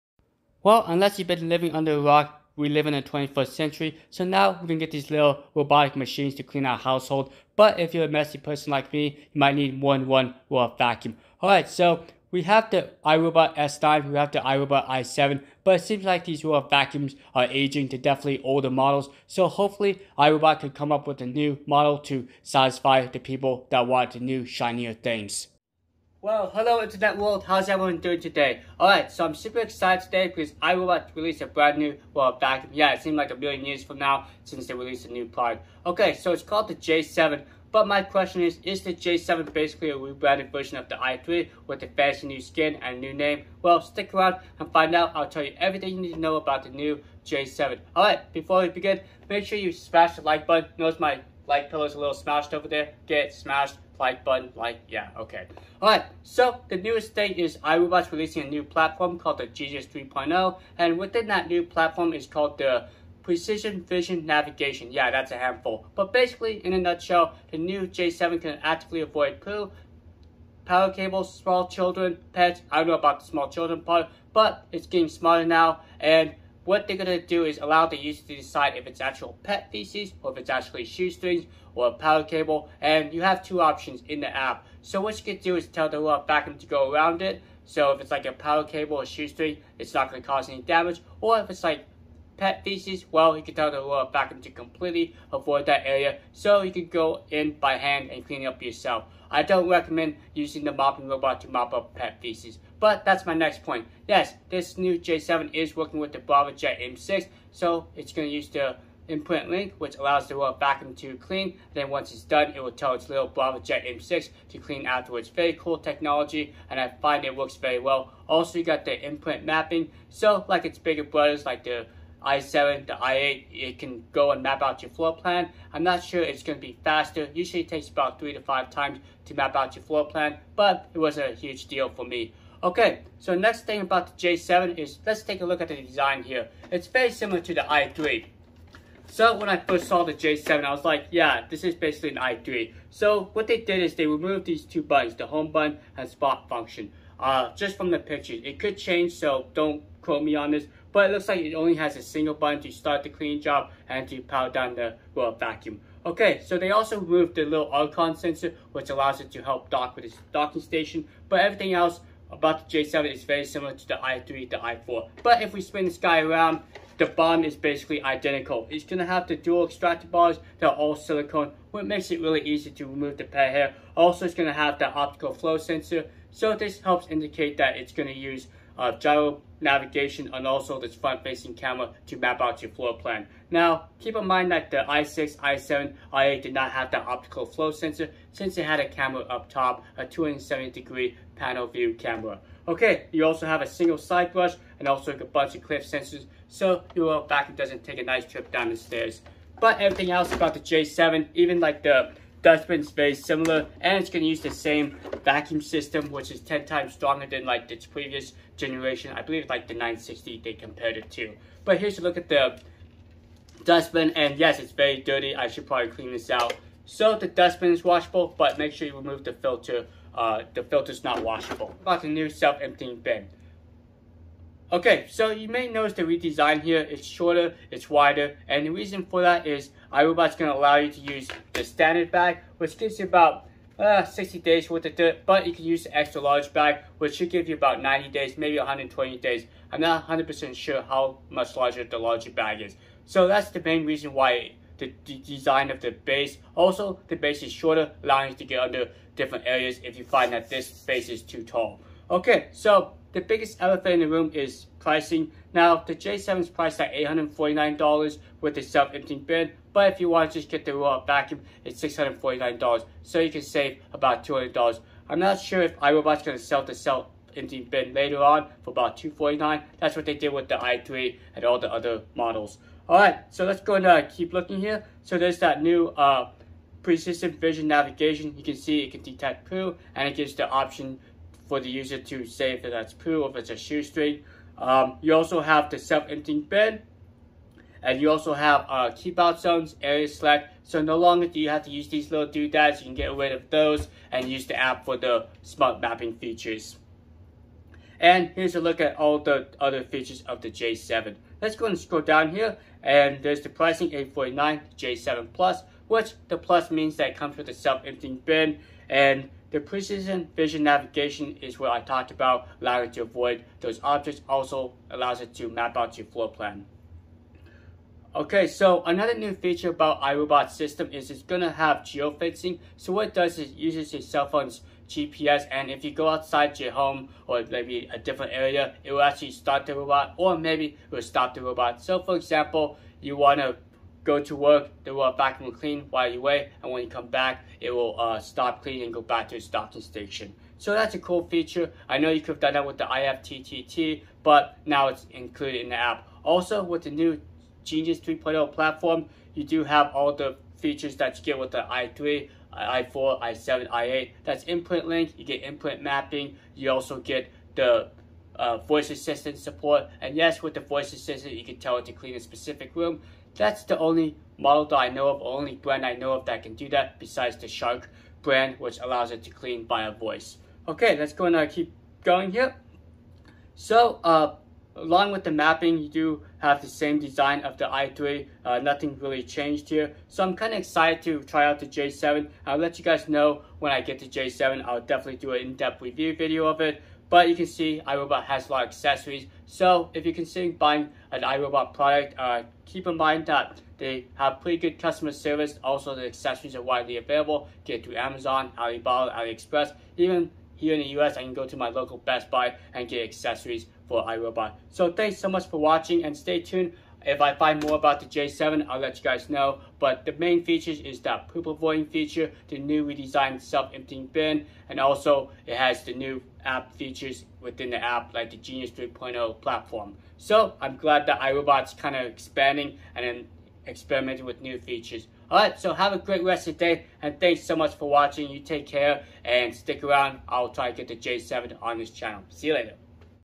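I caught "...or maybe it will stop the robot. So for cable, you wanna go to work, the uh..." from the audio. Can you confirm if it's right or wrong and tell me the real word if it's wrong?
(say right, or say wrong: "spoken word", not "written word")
wrong: "example", not "cable".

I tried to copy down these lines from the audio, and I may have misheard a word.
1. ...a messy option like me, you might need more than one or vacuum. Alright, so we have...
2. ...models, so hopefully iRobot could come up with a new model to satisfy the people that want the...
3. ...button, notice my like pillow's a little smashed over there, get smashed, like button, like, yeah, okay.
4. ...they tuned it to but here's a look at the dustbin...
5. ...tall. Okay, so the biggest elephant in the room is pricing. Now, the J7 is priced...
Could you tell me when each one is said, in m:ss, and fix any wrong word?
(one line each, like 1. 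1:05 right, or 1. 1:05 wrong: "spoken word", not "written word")
1. 0:08 wrong: "person", not "option"
2. 0:18 right
3. 0:50 right
4. 3:30 wrong: "compared", not "tuned"
5. 4:11 right.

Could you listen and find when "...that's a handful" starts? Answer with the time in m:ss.
1:05.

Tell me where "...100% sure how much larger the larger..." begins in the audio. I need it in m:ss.
4:00.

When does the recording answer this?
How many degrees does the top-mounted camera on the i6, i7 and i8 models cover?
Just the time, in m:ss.
3:10.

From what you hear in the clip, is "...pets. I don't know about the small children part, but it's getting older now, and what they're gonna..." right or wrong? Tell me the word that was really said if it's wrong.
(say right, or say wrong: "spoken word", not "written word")
wrong: "smarter", not "older".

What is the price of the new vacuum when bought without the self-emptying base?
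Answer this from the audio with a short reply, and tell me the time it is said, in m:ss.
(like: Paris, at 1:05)
$649, at 4:21.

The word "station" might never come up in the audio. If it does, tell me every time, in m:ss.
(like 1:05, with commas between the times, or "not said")
2:40, 5:39.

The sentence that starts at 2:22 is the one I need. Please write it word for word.
So what they did is they removed these two buttons, the home button and spot function.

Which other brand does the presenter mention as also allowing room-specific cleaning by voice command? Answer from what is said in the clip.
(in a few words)
Shark.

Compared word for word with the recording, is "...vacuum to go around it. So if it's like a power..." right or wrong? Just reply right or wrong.
right.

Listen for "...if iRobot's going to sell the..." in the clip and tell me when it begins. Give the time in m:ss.
4:25.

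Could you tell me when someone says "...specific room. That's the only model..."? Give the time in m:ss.
6:02.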